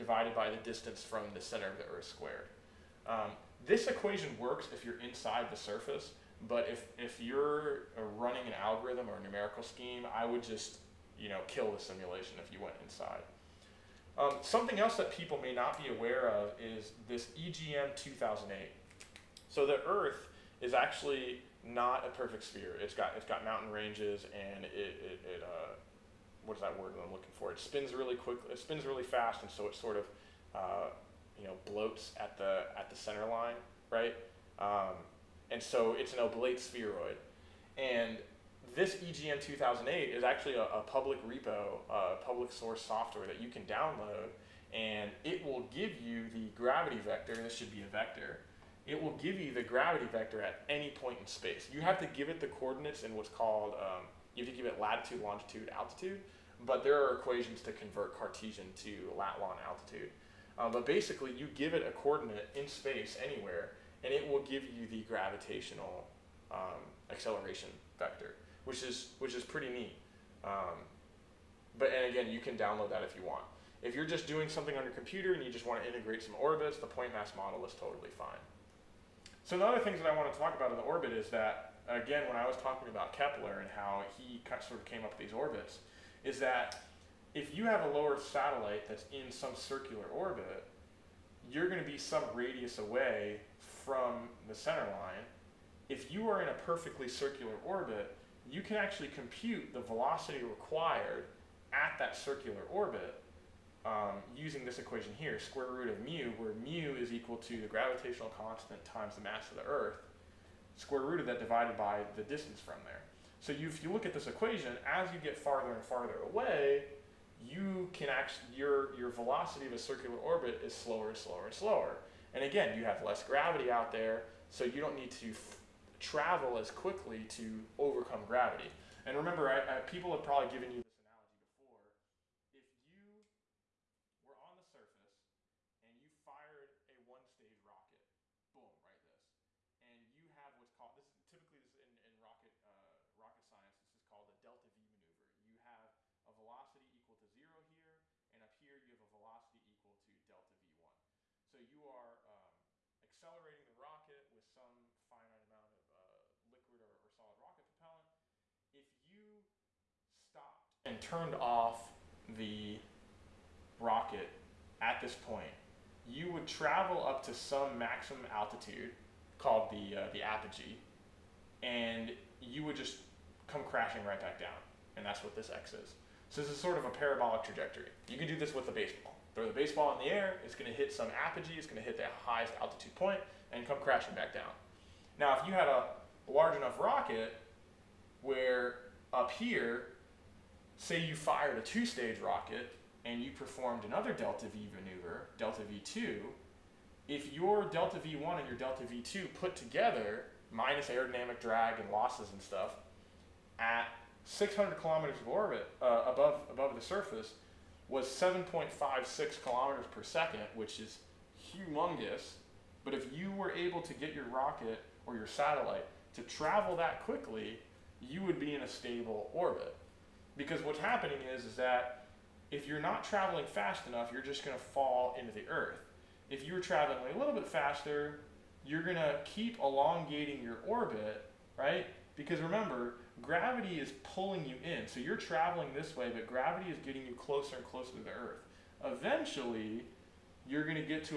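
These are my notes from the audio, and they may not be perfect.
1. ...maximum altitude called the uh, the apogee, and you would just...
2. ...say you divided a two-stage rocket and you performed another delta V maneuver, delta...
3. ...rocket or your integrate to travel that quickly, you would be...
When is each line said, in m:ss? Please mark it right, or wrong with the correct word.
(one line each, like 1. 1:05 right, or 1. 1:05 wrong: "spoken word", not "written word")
1. 2:47 right
2. 3:10 wrong: "fired", not "divided"
3. 3:34 wrong: "satellite", not "integrate".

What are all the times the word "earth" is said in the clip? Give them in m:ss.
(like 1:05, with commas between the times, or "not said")
0:01, 0:19, 1:49, 3:45, 3:58.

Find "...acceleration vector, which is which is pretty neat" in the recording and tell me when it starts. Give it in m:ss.
1:07.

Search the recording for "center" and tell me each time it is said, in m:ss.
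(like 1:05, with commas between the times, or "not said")
0:01, 0:32, 1:34.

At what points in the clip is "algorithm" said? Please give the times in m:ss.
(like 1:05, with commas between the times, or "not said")
0:08.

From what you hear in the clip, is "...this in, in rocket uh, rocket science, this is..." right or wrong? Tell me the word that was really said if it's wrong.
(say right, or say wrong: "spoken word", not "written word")
right.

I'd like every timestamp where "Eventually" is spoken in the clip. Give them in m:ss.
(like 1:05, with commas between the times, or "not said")
3:58.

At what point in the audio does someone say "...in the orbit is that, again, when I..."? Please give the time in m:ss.
1:20.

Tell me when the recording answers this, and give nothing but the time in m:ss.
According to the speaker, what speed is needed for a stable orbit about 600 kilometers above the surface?
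3:28.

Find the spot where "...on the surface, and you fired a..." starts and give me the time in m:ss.
2:14.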